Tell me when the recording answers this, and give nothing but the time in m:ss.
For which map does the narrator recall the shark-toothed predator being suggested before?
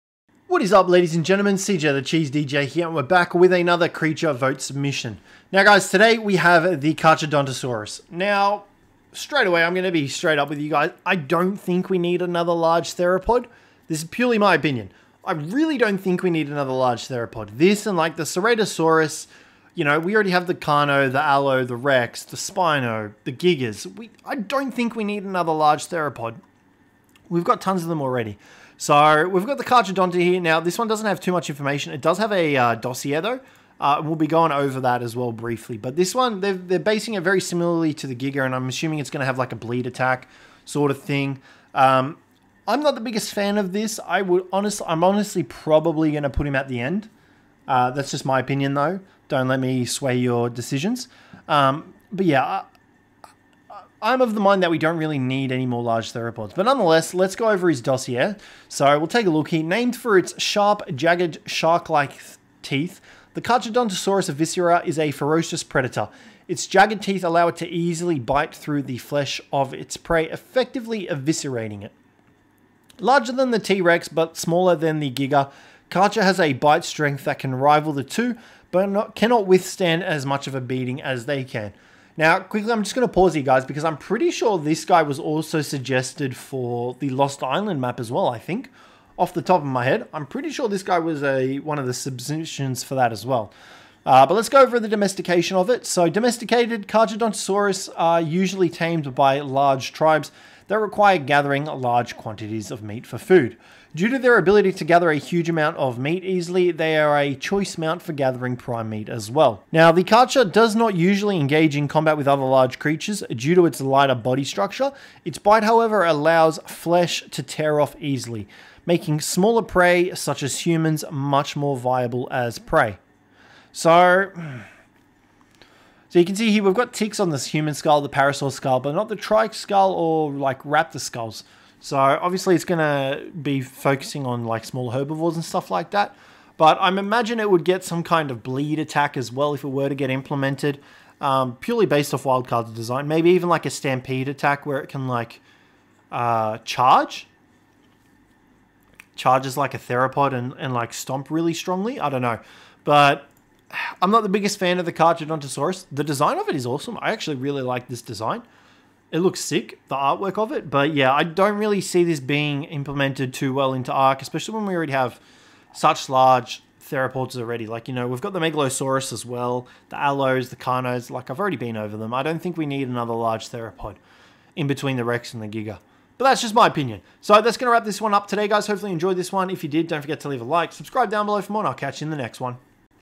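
1:27.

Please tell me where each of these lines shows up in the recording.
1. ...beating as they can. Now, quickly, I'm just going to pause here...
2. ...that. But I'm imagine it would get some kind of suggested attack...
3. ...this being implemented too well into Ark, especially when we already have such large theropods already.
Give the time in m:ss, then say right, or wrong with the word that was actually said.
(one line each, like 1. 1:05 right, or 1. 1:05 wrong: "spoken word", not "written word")
1. 1:20 right
2. 2:15 wrong: "bleed", not "suggested"
3. 2:42 right.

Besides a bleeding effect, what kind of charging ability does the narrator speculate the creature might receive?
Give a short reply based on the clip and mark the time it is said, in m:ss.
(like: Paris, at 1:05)
stampede attack, at 2:23.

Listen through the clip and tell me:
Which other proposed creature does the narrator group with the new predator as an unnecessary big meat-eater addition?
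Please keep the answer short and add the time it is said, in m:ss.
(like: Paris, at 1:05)
Ceratosaurus, at 0:18.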